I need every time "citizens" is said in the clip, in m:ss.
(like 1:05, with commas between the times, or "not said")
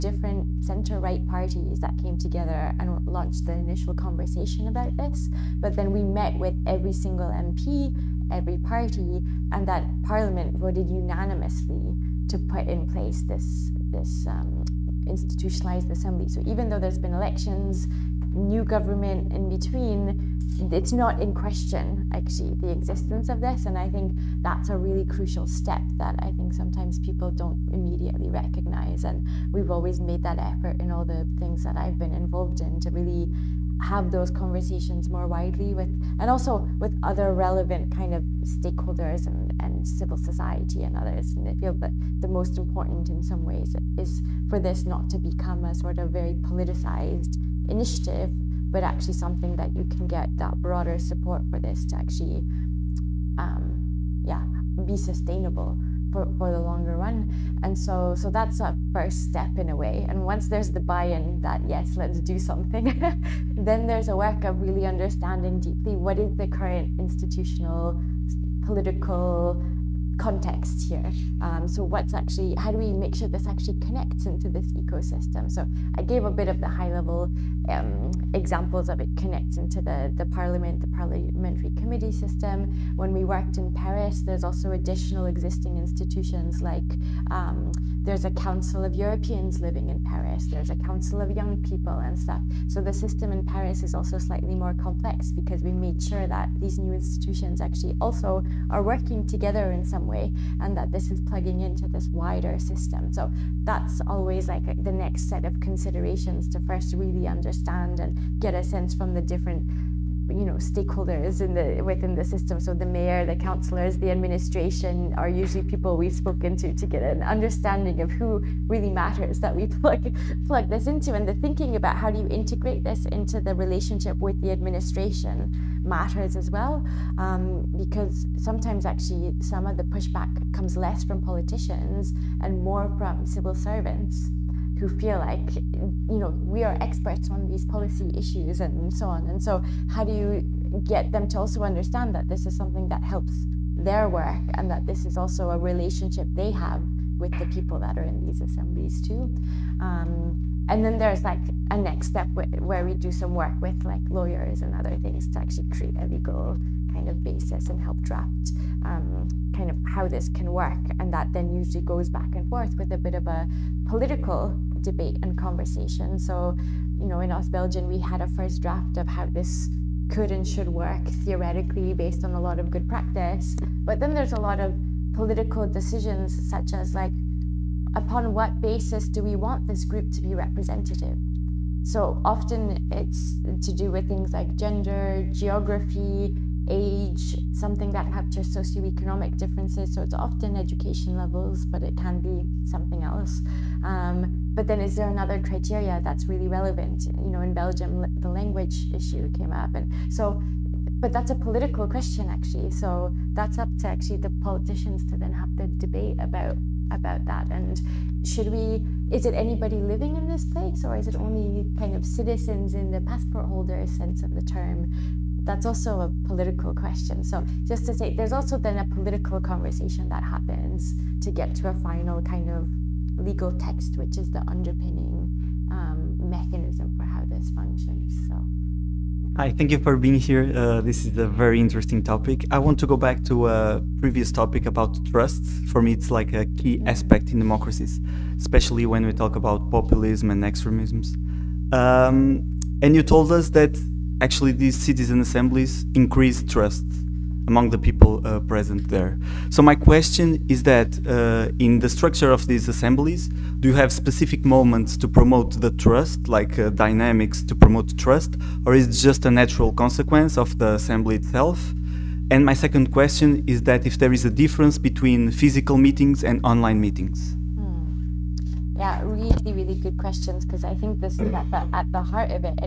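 3:32, 4:04.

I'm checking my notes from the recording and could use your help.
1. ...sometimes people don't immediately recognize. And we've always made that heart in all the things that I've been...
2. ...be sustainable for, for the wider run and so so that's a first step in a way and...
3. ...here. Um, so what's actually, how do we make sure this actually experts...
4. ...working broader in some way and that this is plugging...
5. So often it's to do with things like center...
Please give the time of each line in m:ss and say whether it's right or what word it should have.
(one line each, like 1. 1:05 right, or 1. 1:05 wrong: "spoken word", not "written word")
1. 0:26 wrong: "effort", not "heart"
2. 0:54 wrong: "longer", not "wider"
3. 1:10 wrong: "connects", not "experts"
4. 1:38 wrong: "together", not "broader"
5. 3:01 wrong: "gender", not "center".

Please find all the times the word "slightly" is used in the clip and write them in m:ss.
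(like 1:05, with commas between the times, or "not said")
1:34.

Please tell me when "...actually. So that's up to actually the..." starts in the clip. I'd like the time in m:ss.
3:22.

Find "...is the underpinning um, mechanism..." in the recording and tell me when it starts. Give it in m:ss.
3:44.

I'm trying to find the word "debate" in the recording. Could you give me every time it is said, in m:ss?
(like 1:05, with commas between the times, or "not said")
2:44, 3:25.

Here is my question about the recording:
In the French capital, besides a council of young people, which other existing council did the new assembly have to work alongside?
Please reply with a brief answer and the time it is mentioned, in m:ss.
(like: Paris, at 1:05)
Council of Europeans living in Paris, at 1:28.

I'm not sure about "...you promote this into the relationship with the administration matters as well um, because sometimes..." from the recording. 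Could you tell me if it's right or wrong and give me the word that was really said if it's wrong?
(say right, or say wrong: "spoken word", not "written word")
wrong: "integrate", not "promote".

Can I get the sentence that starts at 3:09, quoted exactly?
So it's often education levels, but it can be something else.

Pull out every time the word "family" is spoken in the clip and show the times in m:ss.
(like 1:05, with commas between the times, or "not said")
not said.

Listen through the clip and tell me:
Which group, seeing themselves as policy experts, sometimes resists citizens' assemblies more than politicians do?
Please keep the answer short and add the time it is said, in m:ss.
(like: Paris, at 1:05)
Civil servants, at 2:13.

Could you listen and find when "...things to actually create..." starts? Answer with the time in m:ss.
2:34.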